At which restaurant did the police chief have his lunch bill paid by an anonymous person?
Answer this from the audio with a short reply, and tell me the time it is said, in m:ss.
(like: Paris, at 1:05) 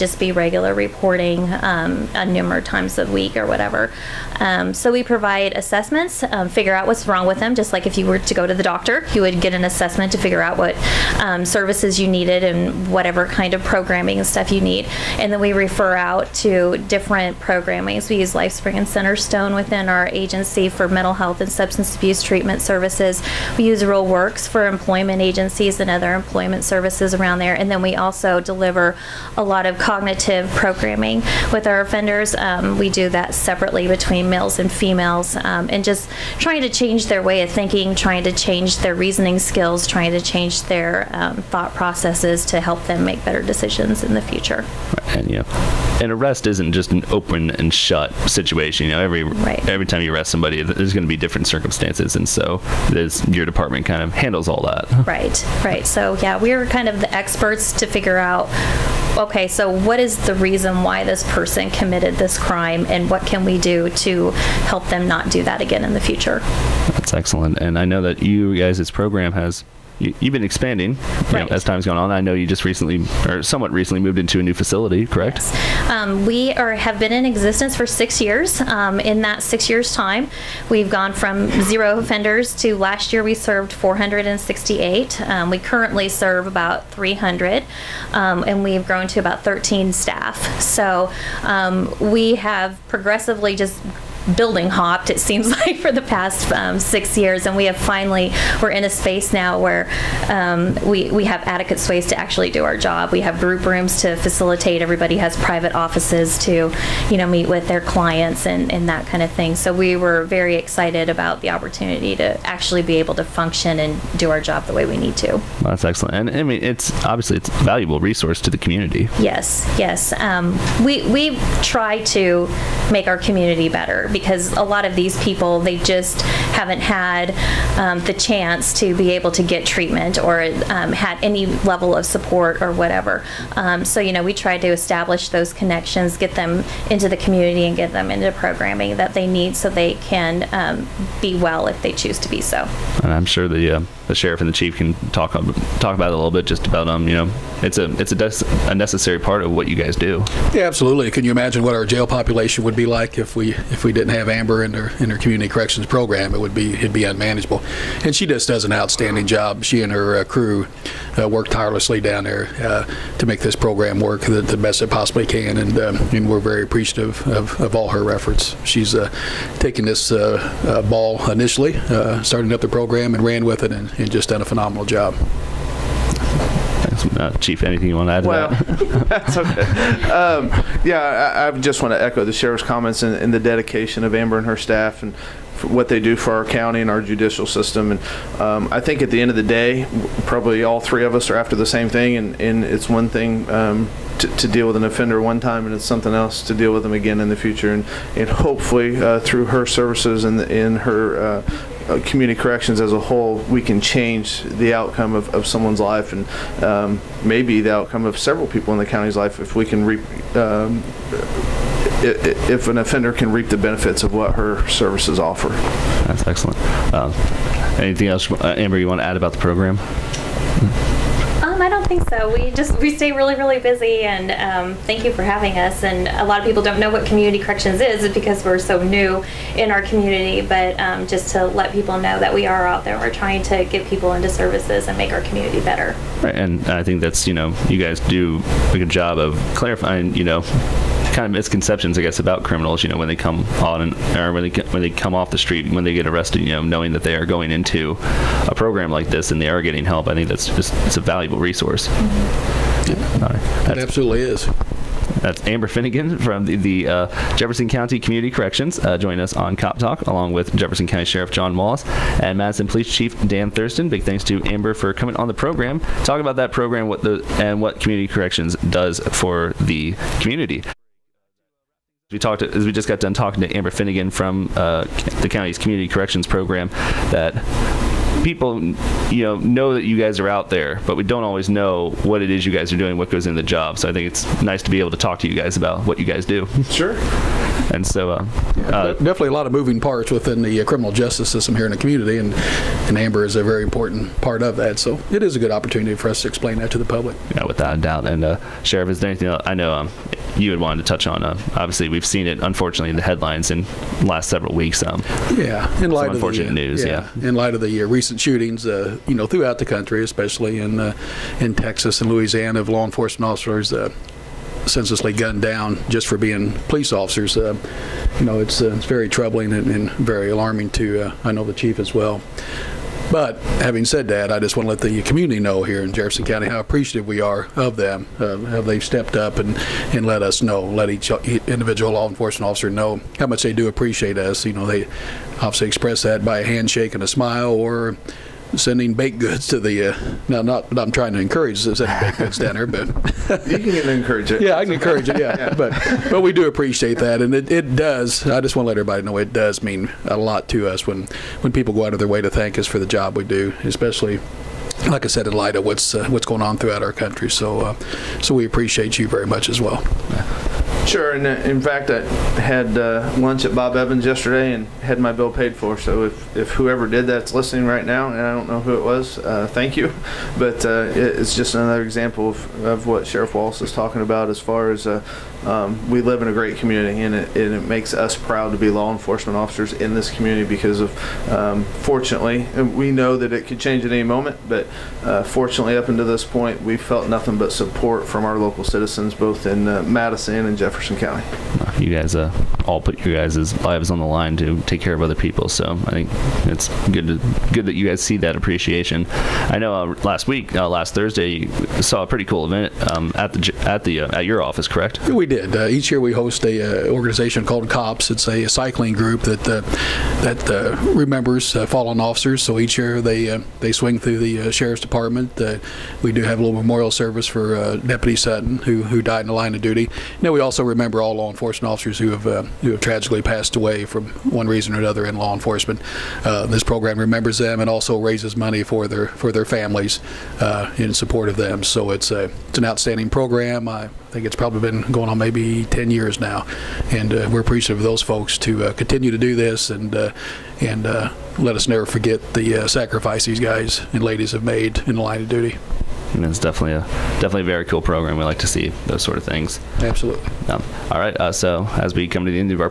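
Bob Evans, at 6:03.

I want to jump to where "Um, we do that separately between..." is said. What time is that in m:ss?
0:32.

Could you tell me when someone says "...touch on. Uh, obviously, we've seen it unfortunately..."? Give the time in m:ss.
5:00.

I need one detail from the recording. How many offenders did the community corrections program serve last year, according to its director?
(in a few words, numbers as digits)
468.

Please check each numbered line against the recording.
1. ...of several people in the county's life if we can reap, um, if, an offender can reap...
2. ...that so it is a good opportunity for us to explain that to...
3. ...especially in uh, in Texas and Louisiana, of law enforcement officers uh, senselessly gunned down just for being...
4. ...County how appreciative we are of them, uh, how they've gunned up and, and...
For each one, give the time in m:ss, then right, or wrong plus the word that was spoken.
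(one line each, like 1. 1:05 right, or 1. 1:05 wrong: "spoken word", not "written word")
1. 3:28 right
2. 4:54 right
3. 5:10 right
4. 5:26 wrong: "stepped", not "gunned".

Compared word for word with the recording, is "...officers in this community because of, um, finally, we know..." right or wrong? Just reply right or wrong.
wrong.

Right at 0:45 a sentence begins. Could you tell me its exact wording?
Right, and yeah, an arrest isn't just an open and shut situation.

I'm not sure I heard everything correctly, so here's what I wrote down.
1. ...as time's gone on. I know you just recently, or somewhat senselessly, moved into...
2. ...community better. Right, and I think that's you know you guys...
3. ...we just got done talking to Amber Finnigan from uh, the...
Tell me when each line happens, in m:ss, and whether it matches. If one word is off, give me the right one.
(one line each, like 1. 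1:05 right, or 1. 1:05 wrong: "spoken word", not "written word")
1. 1:11 wrong: "recently", not "senselessly"
2. 3:55 right
3. 4:32 right.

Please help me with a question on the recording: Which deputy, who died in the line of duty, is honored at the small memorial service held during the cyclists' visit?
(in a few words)
Deputy Sutton.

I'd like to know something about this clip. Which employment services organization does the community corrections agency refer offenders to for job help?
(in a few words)
Real Works.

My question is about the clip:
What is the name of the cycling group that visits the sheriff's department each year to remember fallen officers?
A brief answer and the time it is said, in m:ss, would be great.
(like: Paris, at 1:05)
COPS, at 6:47.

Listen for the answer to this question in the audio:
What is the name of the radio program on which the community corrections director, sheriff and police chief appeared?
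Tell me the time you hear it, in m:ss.
4:19.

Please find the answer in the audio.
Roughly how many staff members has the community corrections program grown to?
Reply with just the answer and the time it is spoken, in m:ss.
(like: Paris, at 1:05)
13, at 1:29.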